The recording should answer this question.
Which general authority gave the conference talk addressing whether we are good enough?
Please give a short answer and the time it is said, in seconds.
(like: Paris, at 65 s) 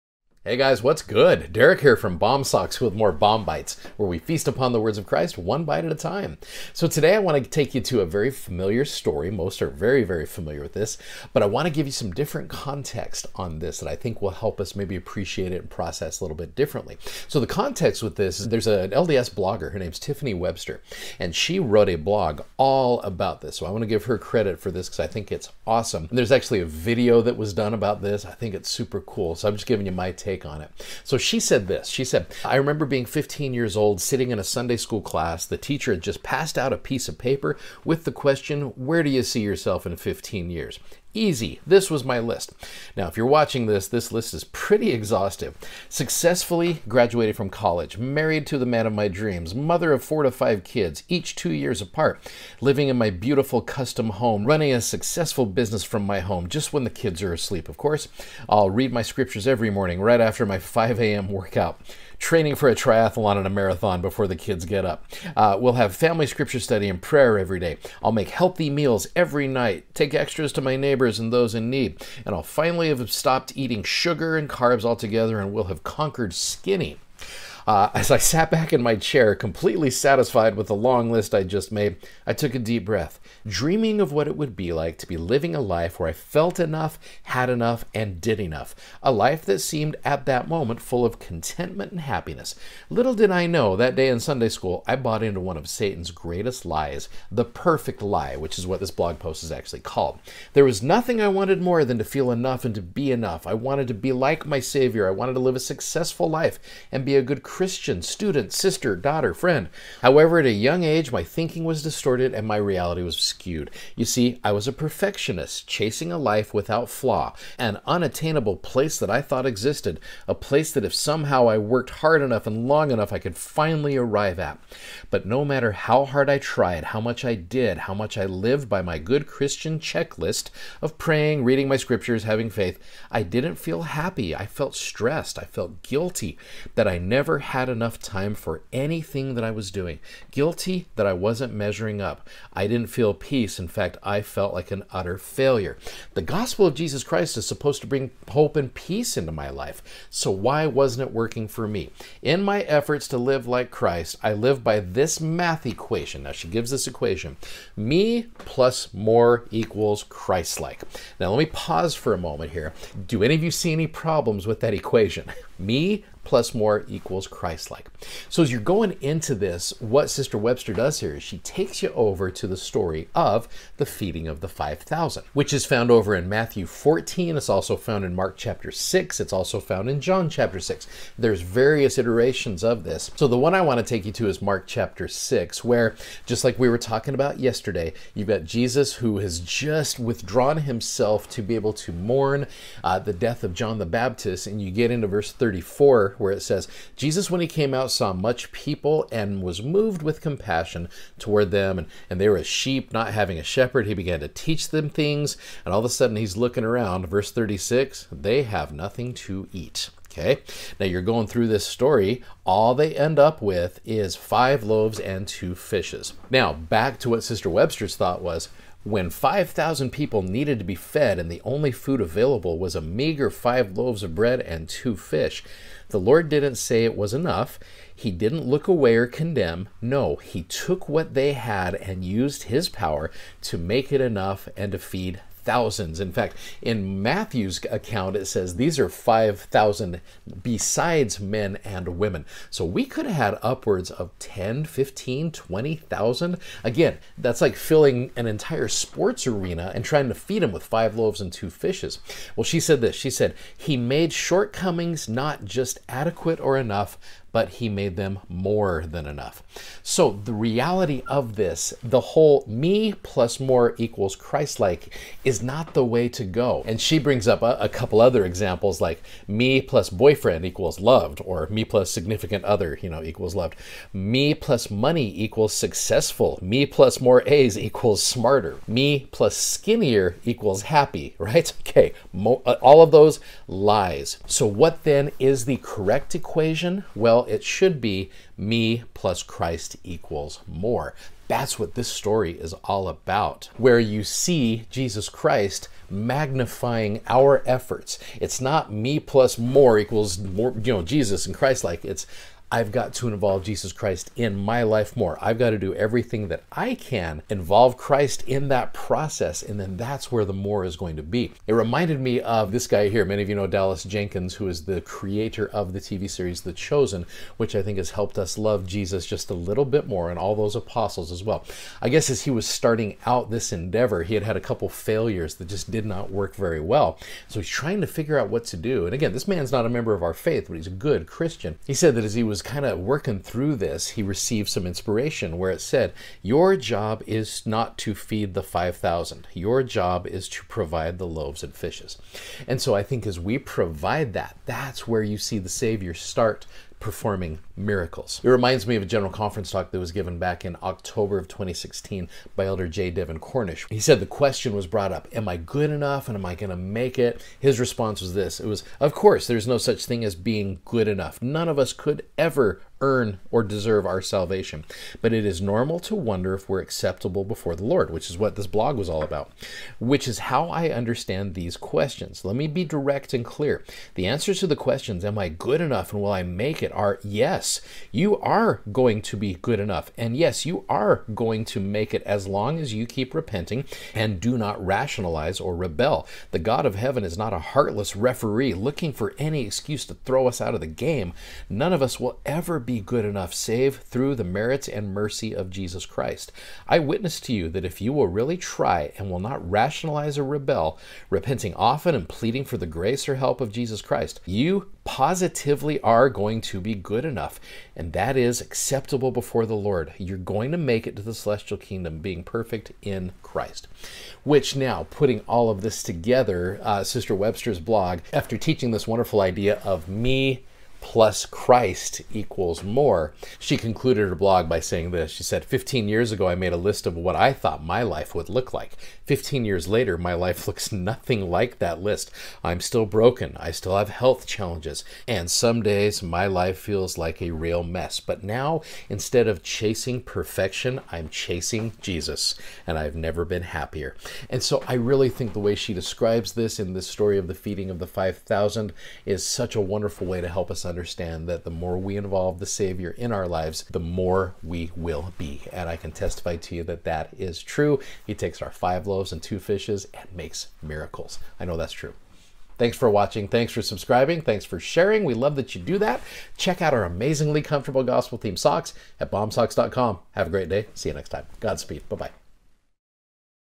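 J. Devin Cornish, at 352 s.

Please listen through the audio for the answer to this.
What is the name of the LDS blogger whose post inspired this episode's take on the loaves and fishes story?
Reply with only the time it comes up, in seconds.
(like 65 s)
19 s.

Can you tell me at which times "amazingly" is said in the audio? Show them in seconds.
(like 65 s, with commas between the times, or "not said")
466 s.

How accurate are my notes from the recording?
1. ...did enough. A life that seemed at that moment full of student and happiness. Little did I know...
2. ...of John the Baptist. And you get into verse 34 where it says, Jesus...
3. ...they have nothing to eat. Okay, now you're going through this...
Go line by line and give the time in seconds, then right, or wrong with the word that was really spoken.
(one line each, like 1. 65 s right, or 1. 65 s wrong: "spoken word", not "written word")
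1. 88 s wrong: "contentment", not "student"
2. 193 s right
3. 208 s right.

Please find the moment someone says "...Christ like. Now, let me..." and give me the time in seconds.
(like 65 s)
160 s.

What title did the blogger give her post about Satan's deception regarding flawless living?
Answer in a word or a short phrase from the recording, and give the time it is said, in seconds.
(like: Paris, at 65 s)
The Perfect Lie, at 97 s.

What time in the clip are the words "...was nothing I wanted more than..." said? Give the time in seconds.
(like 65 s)
100 s.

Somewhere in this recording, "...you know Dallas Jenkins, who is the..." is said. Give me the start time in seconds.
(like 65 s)
313 s.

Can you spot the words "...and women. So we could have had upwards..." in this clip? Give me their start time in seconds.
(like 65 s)
241 s.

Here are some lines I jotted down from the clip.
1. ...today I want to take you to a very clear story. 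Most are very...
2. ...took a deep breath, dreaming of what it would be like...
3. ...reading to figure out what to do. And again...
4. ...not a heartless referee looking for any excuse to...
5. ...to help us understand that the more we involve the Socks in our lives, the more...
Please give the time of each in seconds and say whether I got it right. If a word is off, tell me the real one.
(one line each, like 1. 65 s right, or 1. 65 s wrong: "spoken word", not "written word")
1. 6 s wrong: "familiar", not "clear"
2. 82 s right
3. 327 s wrong: "trying", not "reading"
4. 387 s right
5. 450 s wrong: "Savior", not "Socks".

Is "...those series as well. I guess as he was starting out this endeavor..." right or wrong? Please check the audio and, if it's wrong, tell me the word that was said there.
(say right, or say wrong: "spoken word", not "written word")
wrong: "apostles", not "series".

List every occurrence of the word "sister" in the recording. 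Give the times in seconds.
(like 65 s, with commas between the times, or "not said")
108 s, 170 s, 217 s, 416 s.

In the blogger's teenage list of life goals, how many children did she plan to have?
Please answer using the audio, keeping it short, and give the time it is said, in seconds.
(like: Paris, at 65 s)
4 to 5, at 50 s.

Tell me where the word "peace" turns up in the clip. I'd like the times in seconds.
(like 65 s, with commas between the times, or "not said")
143 s, 148 s.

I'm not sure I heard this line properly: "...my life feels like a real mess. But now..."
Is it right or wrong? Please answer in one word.
right.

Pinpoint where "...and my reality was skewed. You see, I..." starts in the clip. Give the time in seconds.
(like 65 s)
112 s.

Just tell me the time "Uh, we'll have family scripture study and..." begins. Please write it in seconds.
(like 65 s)
65 s.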